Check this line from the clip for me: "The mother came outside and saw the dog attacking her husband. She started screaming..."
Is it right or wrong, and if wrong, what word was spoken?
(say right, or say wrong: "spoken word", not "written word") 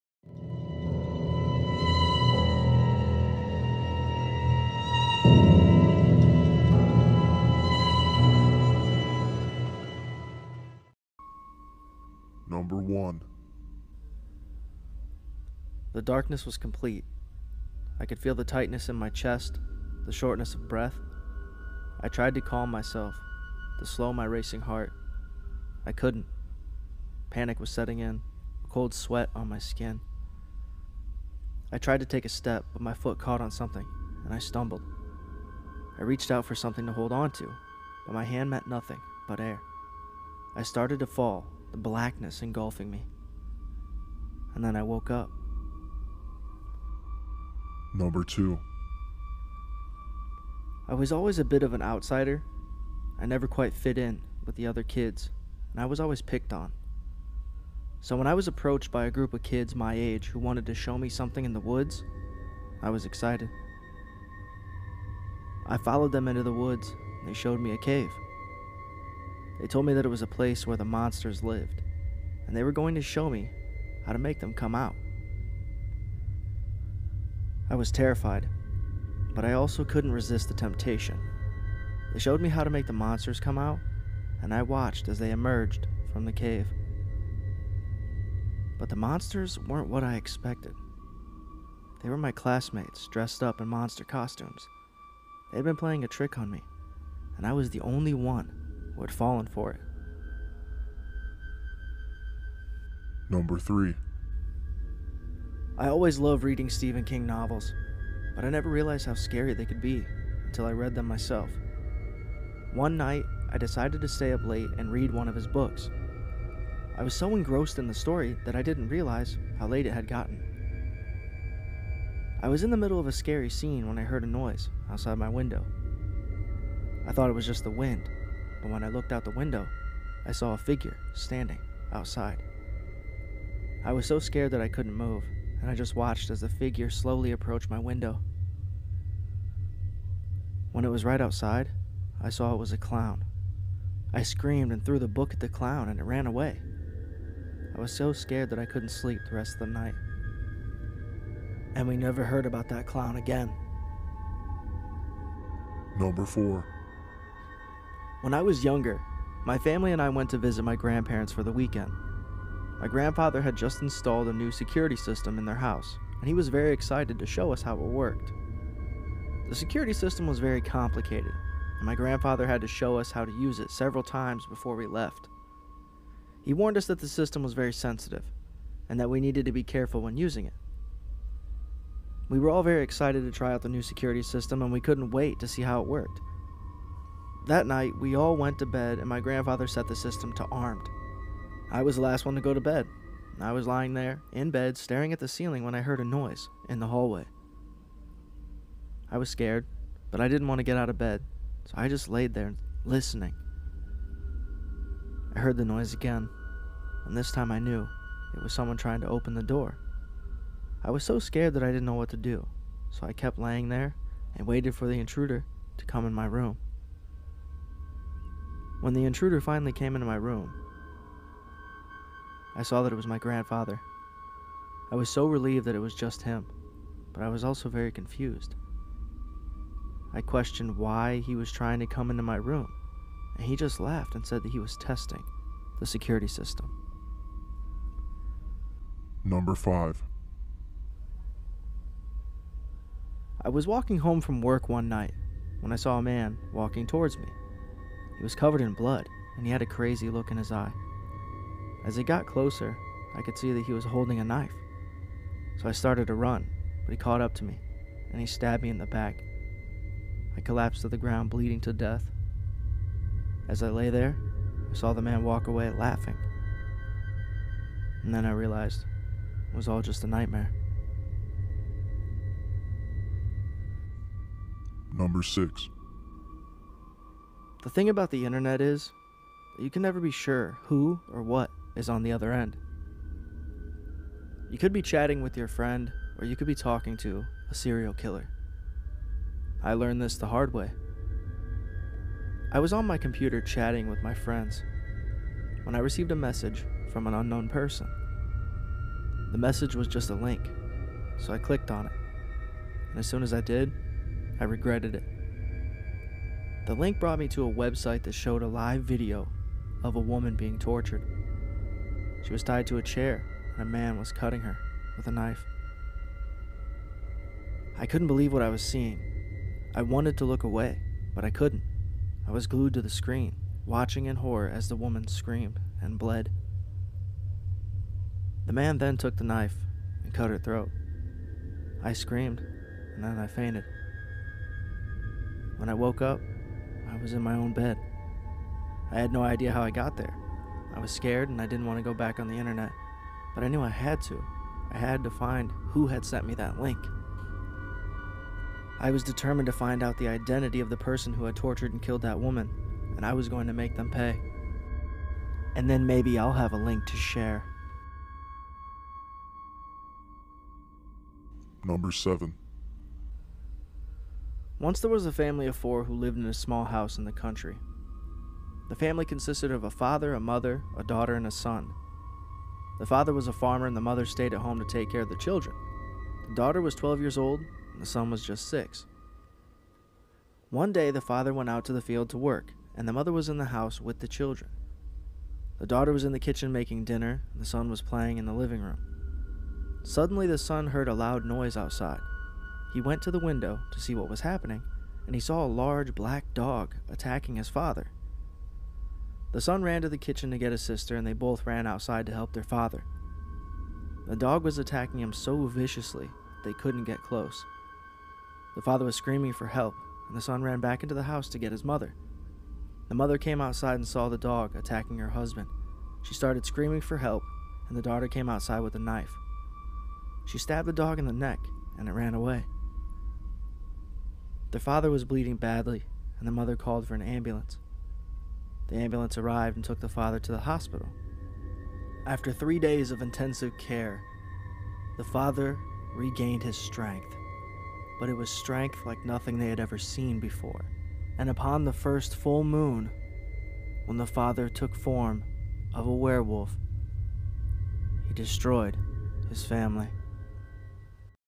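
right.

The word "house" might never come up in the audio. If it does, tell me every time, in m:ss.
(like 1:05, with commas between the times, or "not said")
2:45, 6:06, 6:23, 6:51.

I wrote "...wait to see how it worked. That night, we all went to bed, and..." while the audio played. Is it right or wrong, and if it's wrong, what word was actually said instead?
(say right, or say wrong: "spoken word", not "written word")
right.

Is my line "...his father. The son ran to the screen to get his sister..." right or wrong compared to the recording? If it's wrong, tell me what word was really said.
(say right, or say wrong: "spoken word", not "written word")
wrong: "kitchen", not "screen".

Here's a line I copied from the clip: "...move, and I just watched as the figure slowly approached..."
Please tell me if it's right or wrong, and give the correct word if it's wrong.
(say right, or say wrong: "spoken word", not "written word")
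right.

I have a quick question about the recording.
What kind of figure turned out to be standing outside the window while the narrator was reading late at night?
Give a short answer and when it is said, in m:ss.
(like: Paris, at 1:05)
A clown, at 2:22.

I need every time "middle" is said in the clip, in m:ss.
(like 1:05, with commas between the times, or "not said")
2:02.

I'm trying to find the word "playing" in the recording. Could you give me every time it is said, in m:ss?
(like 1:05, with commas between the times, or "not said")
1:35, 6:27.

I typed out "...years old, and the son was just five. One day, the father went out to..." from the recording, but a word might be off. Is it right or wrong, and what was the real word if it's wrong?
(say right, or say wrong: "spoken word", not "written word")
wrong: "six", not "five".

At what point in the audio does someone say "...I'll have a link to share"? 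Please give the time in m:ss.
5:56.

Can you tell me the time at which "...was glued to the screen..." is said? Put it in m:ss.
5:22.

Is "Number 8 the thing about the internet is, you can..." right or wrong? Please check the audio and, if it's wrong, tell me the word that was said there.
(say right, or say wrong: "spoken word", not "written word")
wrong: "6", not "8".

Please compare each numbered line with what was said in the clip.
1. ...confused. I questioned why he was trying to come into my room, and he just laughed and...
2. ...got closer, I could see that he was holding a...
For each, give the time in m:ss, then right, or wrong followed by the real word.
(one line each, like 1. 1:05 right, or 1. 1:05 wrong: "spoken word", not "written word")
1. 3:47 right
2. 4:12 right.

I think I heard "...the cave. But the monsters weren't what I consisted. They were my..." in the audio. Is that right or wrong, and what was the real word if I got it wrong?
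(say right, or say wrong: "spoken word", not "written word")
wrong: "expected", not "consisted".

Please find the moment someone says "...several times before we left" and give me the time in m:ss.
2:53.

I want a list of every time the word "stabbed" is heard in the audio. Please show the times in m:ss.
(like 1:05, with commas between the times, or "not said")
4:18, 7:00.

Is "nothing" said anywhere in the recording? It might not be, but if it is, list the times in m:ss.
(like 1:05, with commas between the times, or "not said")
0:38, 7:19.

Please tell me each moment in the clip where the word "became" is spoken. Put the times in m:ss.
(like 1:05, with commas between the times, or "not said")
not said.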